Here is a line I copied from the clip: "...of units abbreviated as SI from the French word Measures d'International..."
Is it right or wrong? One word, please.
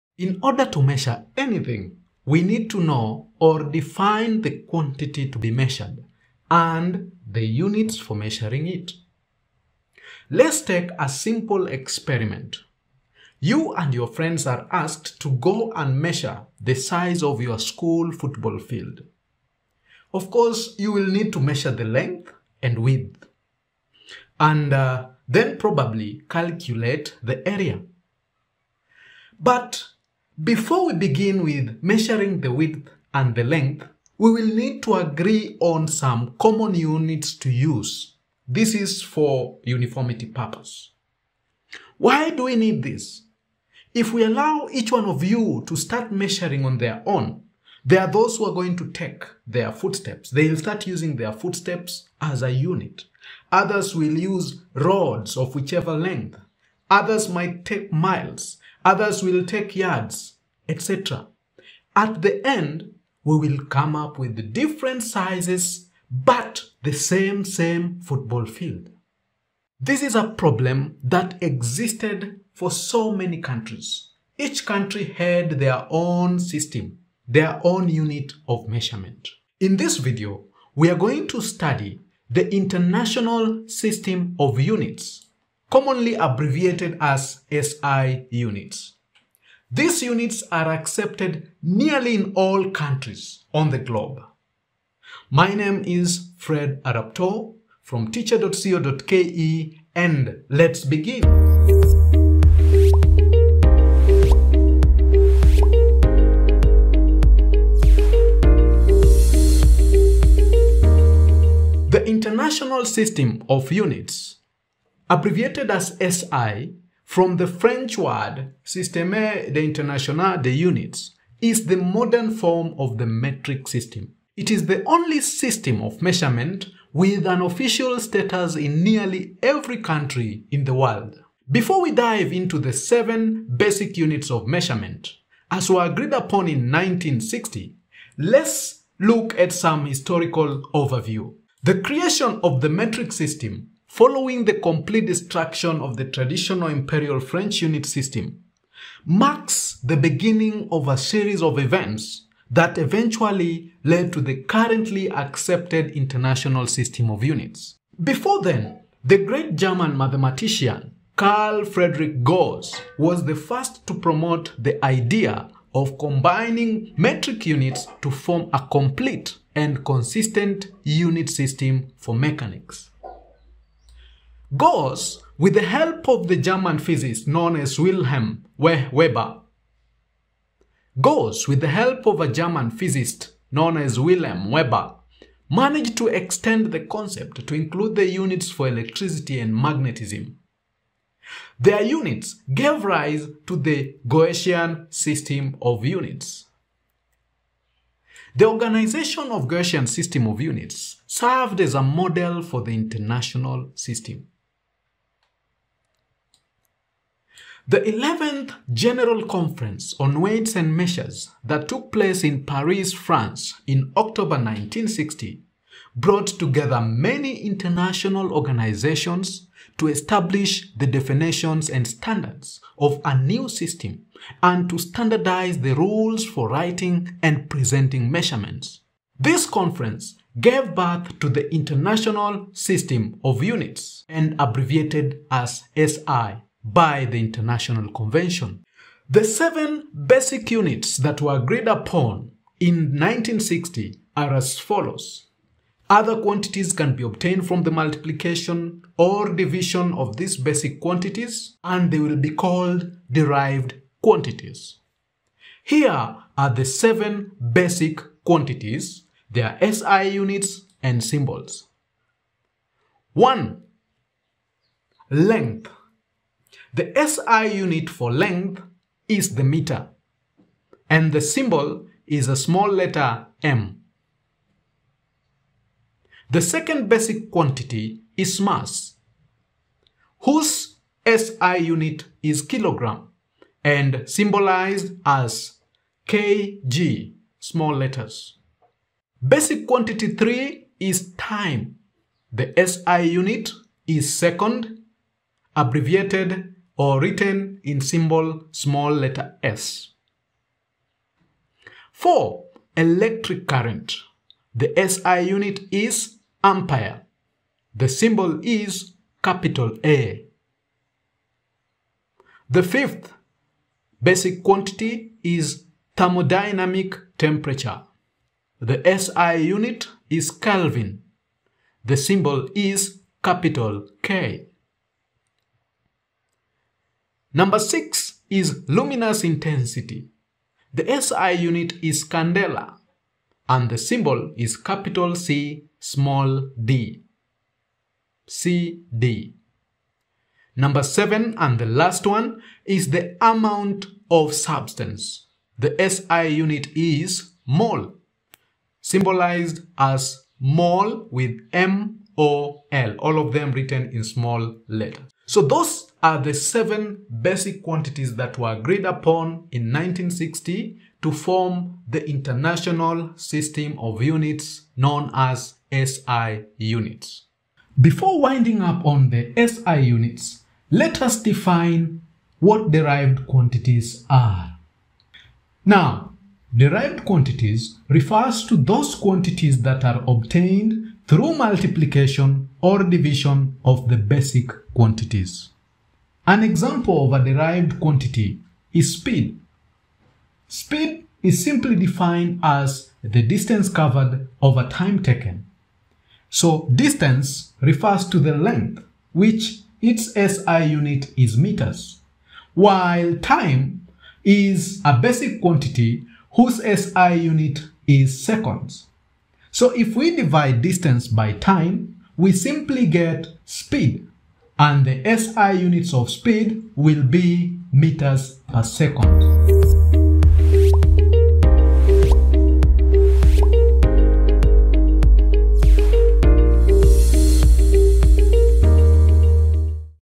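wrong.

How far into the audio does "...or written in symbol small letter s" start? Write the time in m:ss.
4:56.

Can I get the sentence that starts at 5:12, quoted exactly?
The fifth basic quantity is thermodynamic temperature.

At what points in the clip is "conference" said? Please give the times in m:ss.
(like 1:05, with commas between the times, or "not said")
3:29, 3:49.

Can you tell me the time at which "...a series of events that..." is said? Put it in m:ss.
2:30.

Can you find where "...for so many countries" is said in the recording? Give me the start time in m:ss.
1:12.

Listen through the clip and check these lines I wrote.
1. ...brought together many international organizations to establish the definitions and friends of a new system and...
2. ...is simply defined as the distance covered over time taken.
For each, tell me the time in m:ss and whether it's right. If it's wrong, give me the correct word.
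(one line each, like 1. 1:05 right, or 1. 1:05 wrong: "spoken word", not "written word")
1. 3:35 wrong: "standards", not "friends"
2. 6:31 right.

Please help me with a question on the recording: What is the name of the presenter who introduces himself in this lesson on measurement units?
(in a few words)
Fred Adaptor.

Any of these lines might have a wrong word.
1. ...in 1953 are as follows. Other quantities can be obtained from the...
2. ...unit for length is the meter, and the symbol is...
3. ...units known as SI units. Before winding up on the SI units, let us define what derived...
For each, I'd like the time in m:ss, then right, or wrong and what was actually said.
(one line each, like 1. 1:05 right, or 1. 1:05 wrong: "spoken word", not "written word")
1. 4:02 wrong: "1960", not "1953"
2. 4:27 right
3. 6:04 right.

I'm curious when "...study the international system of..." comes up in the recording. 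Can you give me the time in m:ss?
1:21.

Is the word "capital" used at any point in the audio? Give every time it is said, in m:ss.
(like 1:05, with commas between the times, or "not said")
5:09, 5:23, 5:34.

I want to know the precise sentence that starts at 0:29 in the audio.
But before we begin with measuring the width and the length, we will need to agree on some common units to use.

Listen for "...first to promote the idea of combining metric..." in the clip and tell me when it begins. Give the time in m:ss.
2:43.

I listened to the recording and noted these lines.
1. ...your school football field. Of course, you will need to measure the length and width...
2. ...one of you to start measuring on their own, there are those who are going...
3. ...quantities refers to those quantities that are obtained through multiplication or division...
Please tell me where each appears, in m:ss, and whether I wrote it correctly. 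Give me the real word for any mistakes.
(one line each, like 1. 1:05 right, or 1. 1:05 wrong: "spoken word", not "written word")
1. 0:17 right
2. 0:44 right
3. 6:17 right.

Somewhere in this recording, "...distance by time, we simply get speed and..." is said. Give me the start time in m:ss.
6:50.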